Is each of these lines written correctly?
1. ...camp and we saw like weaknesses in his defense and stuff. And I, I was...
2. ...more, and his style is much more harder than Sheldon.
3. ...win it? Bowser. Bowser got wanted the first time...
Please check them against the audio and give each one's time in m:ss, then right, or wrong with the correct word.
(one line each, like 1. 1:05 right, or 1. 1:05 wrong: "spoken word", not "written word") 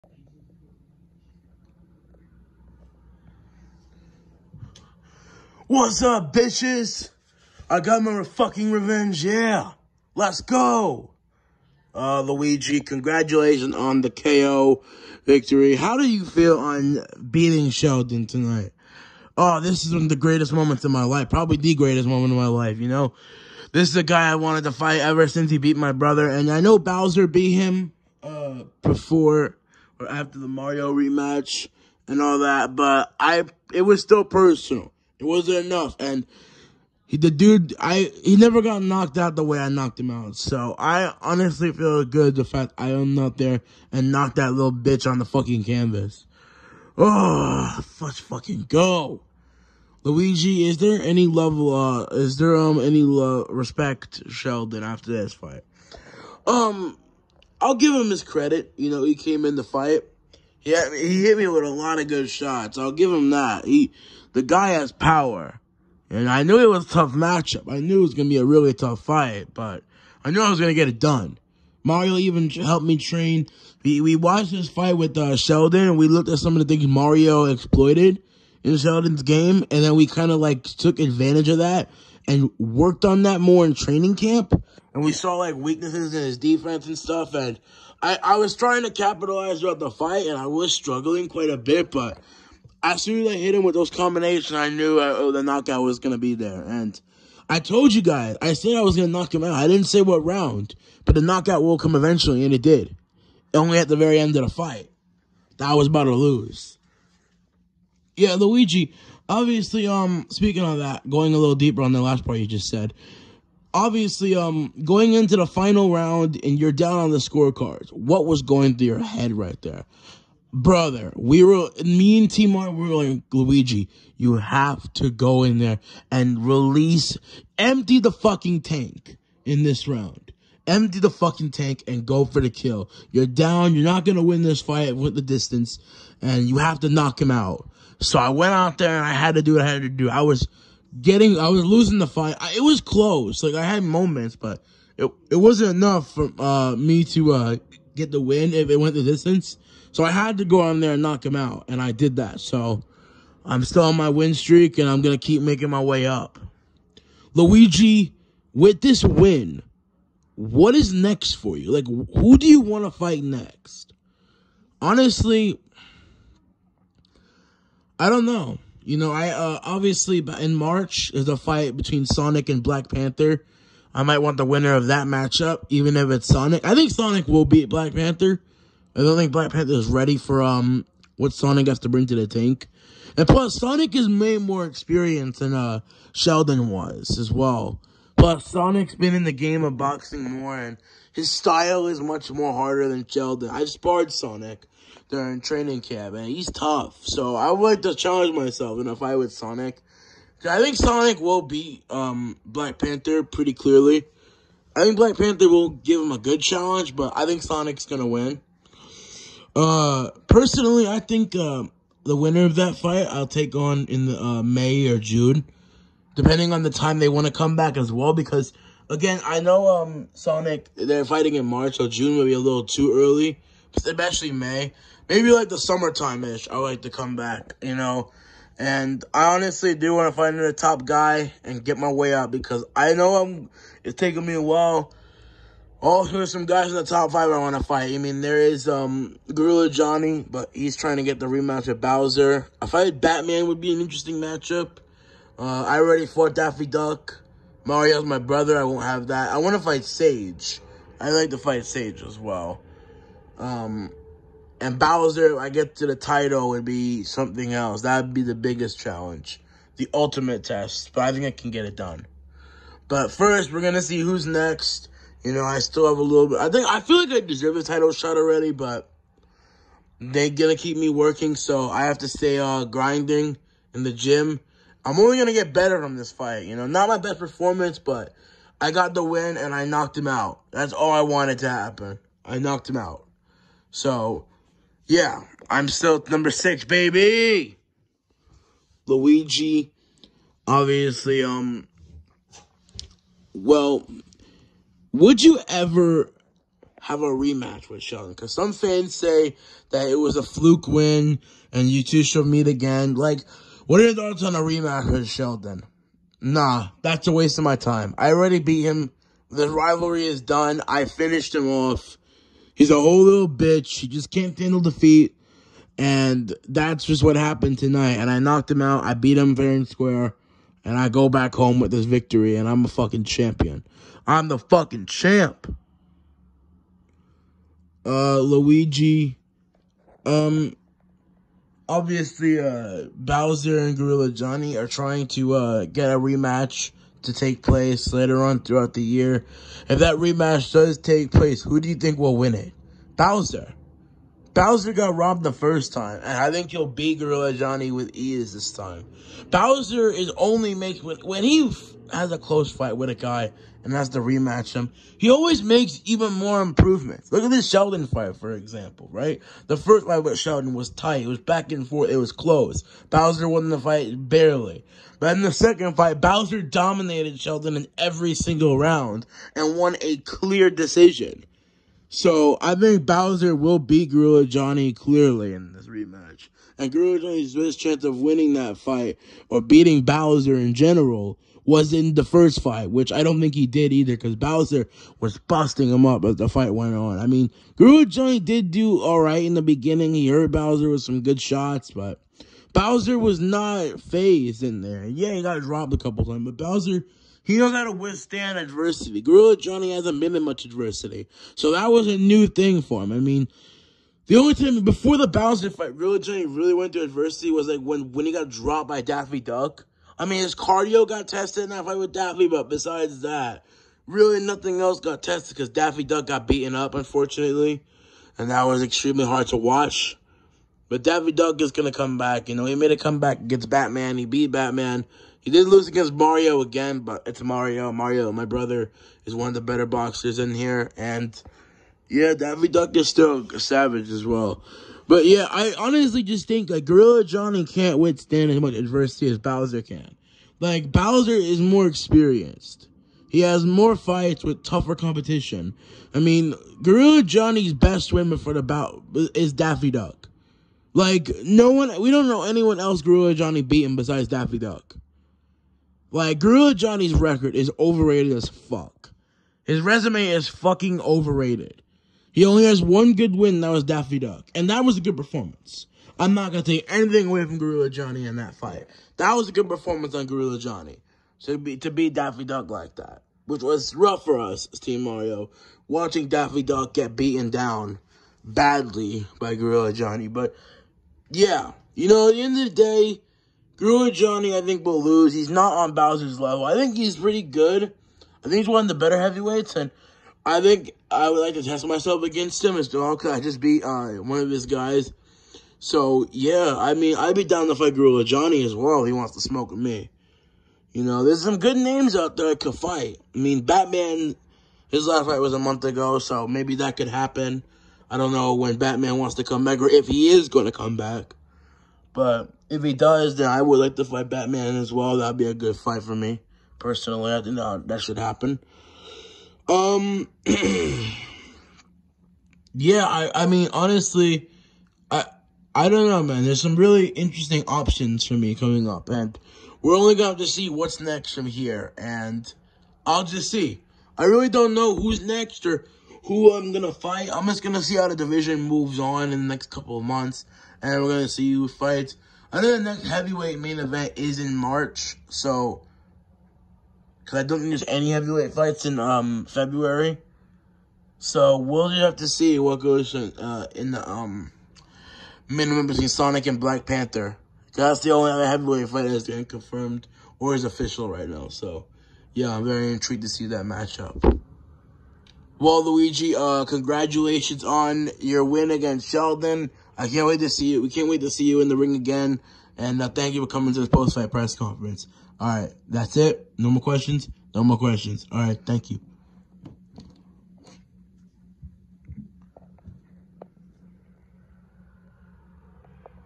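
1. 1:24 right
2. 3:10 right
3. 5:42 wrong: "robbed", not "wanted".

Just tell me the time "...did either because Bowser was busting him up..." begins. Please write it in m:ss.
6:23.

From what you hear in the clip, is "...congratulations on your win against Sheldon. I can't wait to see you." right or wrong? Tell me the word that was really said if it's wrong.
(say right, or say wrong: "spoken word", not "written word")
right.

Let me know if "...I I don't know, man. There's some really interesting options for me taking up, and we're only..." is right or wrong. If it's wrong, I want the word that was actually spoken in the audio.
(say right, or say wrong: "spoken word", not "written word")
wrong: "coming", not "taking".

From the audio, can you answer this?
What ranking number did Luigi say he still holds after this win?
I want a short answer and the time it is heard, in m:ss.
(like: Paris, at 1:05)
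6, at 4:46.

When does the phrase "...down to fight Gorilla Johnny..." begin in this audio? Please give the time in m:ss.
8:17.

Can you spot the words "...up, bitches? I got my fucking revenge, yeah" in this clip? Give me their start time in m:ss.
0:06.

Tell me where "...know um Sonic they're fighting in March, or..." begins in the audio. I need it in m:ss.
3:39.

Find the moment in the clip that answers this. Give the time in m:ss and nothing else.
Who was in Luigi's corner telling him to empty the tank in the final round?
2:02.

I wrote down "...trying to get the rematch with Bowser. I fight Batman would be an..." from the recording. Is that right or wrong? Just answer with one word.
right.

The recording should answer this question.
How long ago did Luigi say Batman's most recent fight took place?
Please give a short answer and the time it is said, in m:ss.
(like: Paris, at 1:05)
a month ago, at 8:25.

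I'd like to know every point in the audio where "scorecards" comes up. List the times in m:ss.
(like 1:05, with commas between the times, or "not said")
1:57.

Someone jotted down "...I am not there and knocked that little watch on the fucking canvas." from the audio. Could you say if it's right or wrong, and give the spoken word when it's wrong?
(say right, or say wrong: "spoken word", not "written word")
wrong: "bitch", not "watch".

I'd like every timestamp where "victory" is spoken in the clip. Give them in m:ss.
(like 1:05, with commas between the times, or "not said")
0:15, 5:21.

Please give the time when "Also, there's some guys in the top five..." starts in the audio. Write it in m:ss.
3:55.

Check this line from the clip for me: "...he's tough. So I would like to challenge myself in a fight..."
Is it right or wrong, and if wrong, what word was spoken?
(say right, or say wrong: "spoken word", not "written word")
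right.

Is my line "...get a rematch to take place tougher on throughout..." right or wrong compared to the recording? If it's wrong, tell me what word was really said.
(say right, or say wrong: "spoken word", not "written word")
wrong: "later", not "tougher".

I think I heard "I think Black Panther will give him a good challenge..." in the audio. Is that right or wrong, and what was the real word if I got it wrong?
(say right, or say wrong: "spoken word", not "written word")
right.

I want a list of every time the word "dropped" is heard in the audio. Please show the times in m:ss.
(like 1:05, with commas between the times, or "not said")
6:35, 6:48.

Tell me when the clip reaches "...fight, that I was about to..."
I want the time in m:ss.
1:44.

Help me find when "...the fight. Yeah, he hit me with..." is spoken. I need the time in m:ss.
0:59.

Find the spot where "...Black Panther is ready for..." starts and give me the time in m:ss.
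2:59.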